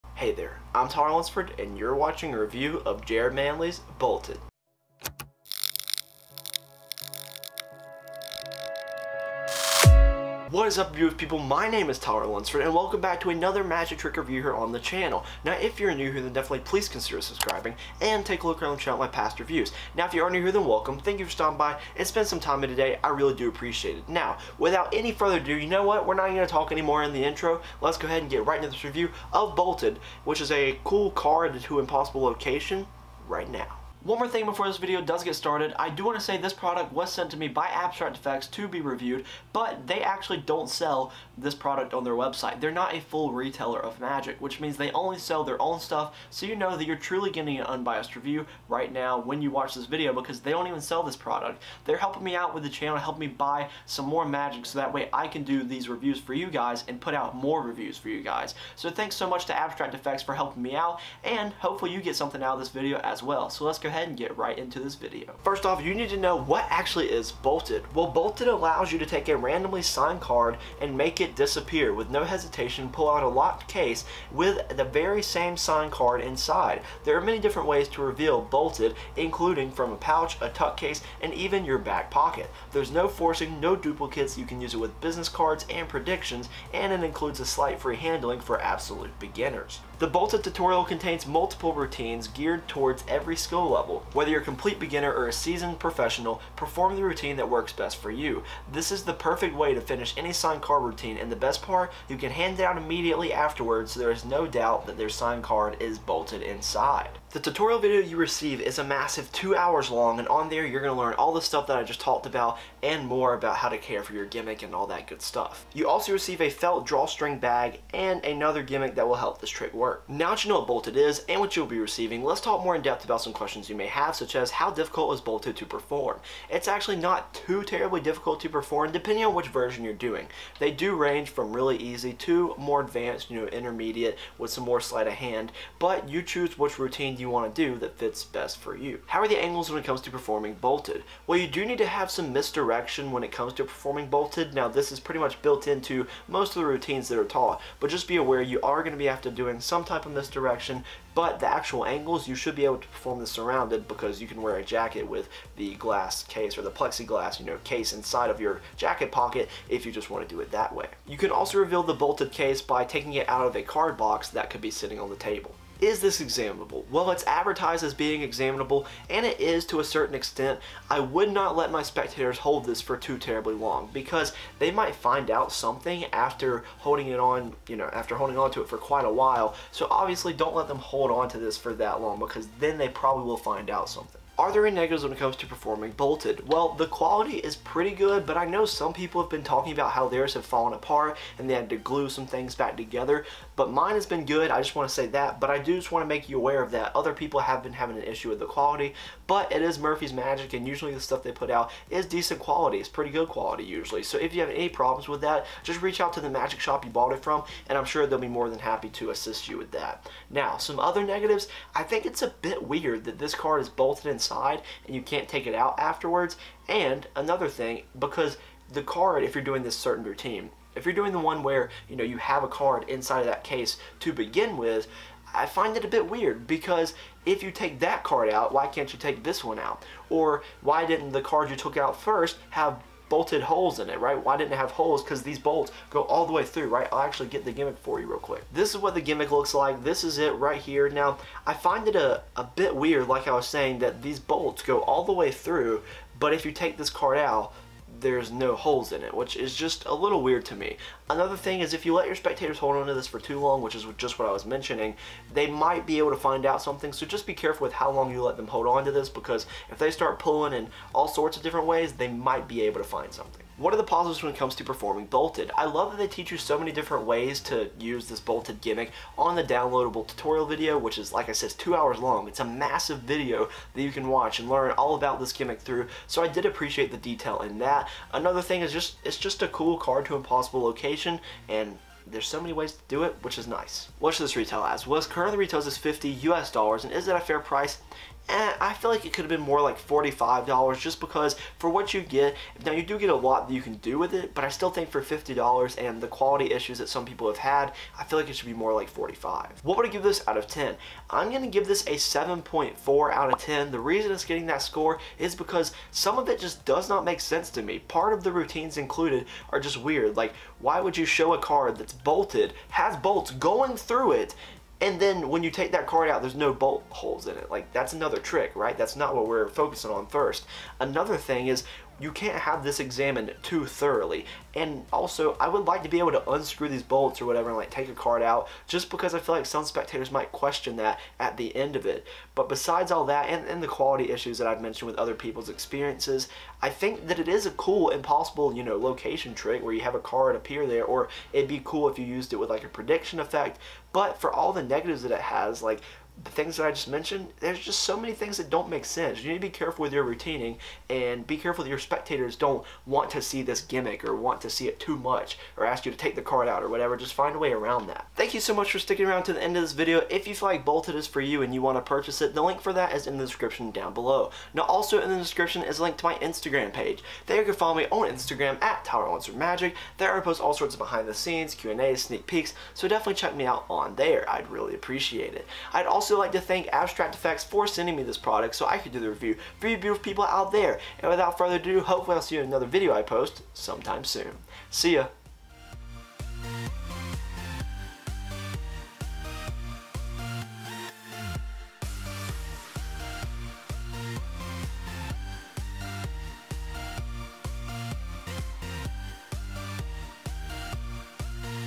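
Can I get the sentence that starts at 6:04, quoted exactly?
Now also in the description is a link to my Instagram page.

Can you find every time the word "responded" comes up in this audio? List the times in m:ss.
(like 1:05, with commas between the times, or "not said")
not said.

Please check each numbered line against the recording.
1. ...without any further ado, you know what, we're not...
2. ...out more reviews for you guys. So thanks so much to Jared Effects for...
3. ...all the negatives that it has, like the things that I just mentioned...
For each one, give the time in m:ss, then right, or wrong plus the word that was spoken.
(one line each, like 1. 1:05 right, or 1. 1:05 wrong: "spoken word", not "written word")
1. 0:24 right
2. 0:57 wrong: "Abstract", not "Jared"
3. 5:44 right.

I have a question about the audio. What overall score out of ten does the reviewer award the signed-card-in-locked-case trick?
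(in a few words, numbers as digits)
7.4.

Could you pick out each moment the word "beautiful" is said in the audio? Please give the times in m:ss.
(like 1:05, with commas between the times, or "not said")
0:10, 6:19.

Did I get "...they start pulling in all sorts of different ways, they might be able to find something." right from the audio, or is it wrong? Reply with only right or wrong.
right.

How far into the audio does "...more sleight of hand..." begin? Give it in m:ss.
2:14.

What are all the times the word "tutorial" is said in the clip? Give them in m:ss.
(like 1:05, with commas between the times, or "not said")
1:30, 1:47, 4:30.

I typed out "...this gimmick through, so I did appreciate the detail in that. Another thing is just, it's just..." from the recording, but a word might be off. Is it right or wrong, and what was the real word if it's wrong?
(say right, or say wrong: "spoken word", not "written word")
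right.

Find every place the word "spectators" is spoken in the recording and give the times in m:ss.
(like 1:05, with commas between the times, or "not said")
2:51, 4:12, 5:29, 5:51.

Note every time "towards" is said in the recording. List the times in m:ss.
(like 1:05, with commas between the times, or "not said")
1:32.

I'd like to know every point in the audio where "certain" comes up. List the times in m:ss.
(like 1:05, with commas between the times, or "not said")
2:49, 3:39.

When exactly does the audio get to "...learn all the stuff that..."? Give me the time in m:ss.
1:50.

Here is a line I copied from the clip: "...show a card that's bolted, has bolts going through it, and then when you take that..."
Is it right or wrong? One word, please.
right.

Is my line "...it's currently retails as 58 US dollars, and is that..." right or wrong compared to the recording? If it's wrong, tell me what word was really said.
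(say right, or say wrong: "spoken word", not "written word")
wrong: "50", not "58".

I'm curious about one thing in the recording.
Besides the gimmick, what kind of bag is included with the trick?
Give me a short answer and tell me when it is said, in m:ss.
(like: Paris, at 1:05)
felt drawstring bag, at 1:56.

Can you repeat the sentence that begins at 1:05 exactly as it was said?
First off, you need to know what actually is Bolted.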